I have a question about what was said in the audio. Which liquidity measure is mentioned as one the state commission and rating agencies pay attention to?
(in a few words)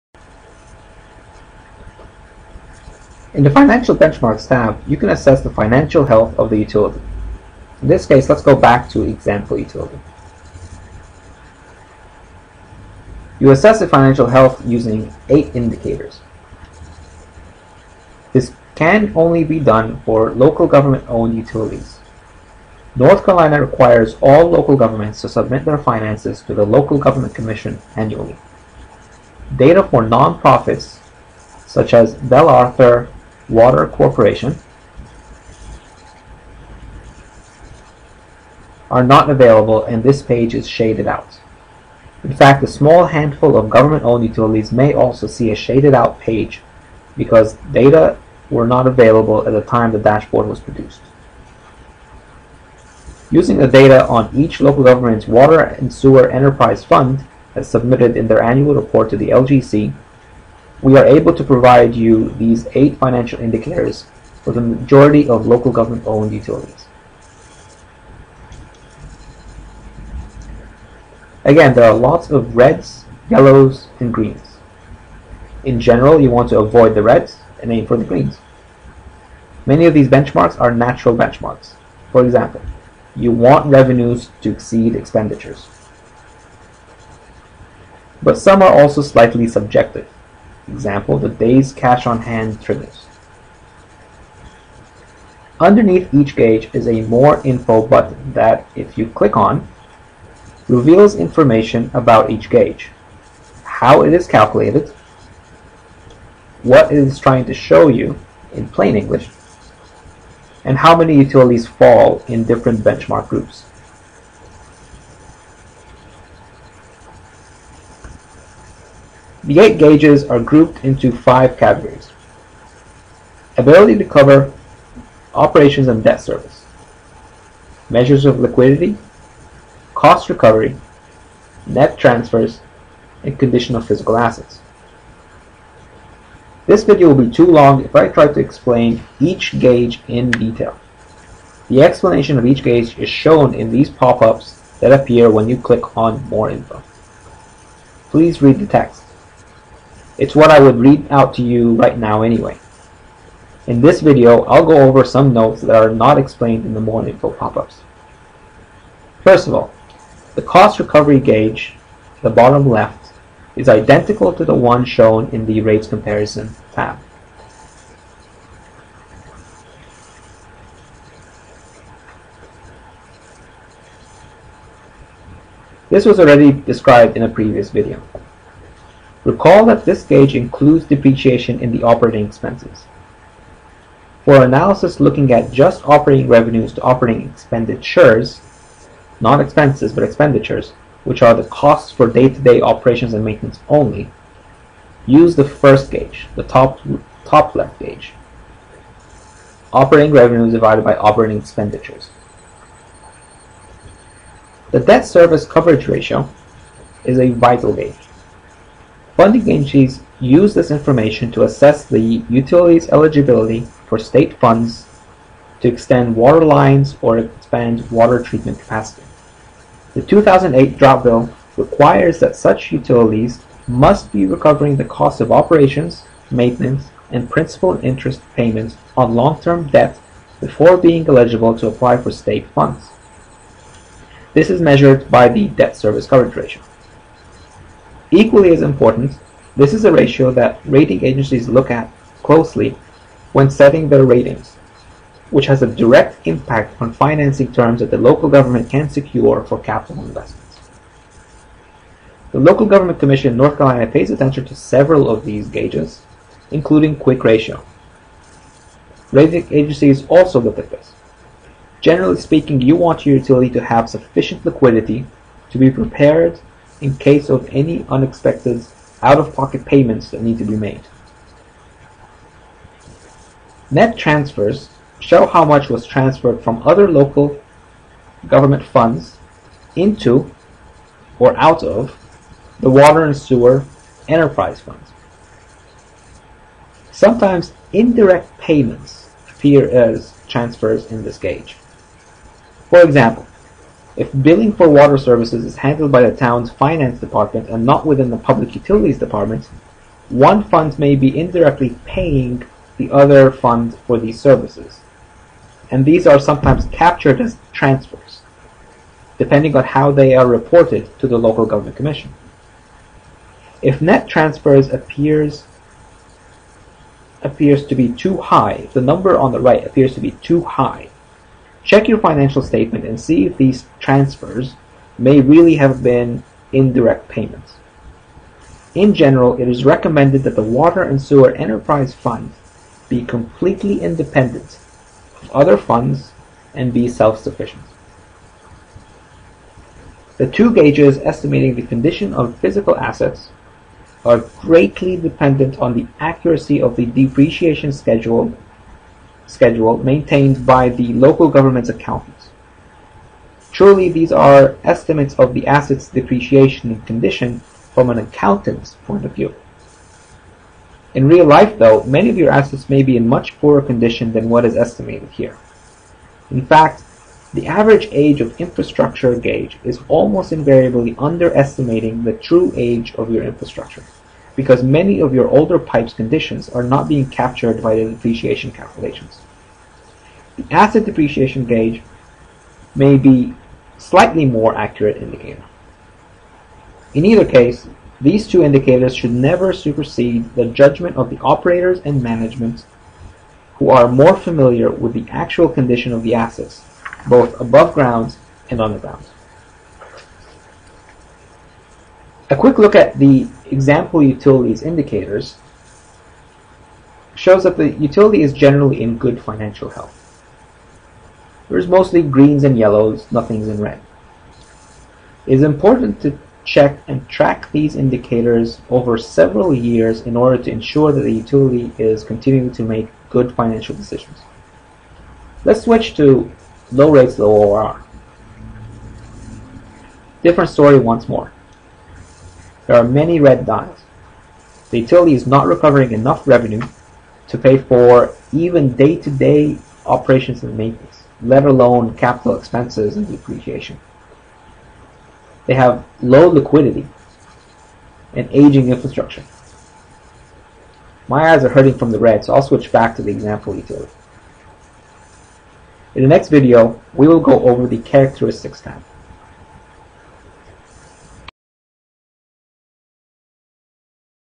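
Quick ratio.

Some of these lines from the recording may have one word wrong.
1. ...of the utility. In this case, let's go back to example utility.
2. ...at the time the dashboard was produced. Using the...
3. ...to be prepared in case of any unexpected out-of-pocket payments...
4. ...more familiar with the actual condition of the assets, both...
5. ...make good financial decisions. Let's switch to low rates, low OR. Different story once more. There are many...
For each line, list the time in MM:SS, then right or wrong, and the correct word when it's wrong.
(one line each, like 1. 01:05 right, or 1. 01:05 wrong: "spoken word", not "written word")
1. 00:06 right
2. 00:49 right
3. 04:25 right
4. 06:33 right
5. 07:02 right.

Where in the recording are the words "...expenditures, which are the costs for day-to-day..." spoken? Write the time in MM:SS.
03:10.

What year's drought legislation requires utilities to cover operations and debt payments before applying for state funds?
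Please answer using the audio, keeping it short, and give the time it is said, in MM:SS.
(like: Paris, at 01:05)
2008, at 03:40.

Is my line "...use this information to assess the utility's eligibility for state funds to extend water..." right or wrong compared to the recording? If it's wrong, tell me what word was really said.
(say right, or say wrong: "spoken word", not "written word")
right.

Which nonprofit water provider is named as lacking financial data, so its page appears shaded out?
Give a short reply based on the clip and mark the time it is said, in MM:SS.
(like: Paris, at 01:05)
Bell Arthur Water Corporation, at 00:32.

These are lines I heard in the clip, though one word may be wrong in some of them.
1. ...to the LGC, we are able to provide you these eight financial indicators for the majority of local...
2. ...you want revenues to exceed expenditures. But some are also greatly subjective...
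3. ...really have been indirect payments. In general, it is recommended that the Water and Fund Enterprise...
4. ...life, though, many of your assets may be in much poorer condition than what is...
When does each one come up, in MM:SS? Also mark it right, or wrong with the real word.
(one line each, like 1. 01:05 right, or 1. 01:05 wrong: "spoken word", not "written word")
1. 00:59 right
2. 01:23 wrong: "slightly", not "greatly"
3. 05:25 wrong: "Sewer", not "Fund"
4. 06:01 right.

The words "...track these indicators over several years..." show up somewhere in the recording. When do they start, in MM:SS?
06:57.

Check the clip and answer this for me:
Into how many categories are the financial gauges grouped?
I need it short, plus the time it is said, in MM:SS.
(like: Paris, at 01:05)
5, at 02:01.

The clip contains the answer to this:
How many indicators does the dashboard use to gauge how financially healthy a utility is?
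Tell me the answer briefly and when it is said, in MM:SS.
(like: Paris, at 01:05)
8, at 00:15.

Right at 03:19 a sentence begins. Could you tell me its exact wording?
Operating revenues divided by operating expenditures.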